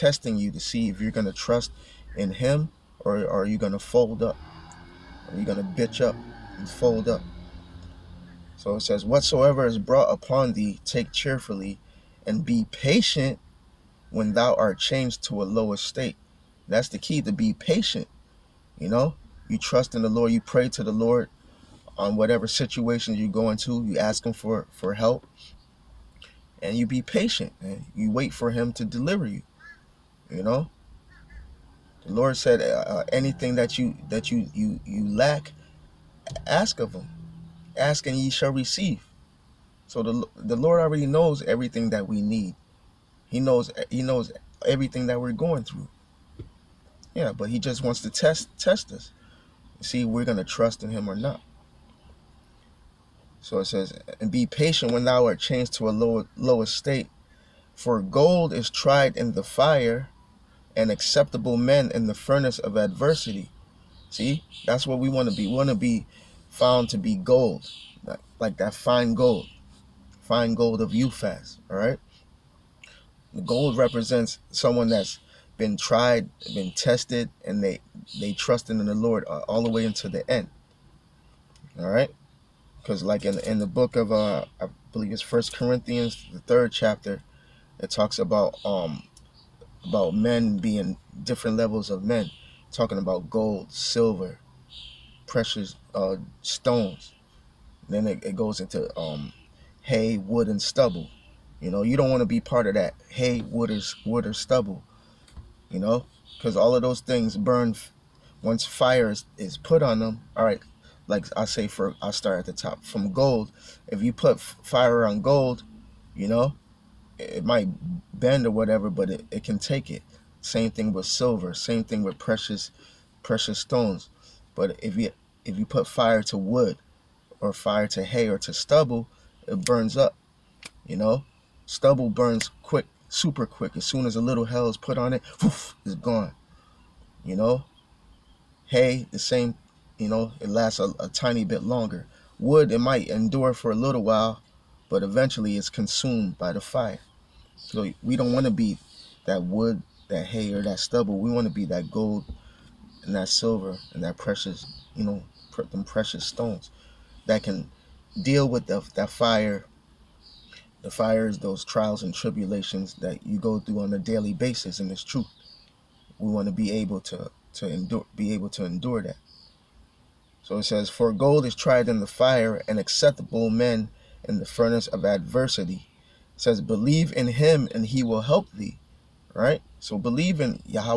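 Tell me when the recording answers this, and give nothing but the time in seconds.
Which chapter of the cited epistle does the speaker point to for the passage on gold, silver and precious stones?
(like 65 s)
86 s.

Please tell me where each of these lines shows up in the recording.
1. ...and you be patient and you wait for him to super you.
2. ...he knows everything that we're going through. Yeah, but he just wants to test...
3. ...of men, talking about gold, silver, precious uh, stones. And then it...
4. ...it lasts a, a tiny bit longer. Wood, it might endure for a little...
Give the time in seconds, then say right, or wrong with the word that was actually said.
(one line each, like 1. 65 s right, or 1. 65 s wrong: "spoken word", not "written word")
1. 26 s wrong: "deliver", not "super"
2. 43 s right
3. 91 s right
4. 140 s right.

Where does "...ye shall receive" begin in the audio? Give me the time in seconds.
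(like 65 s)
38 s.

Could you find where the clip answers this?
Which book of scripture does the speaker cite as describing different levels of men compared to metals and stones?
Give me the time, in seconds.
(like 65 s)
85 s.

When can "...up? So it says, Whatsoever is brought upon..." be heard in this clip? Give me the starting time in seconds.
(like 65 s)
7 s.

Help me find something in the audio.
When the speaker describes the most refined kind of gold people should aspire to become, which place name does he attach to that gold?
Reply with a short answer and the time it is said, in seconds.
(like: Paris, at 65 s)
Uphaz, at 70 s.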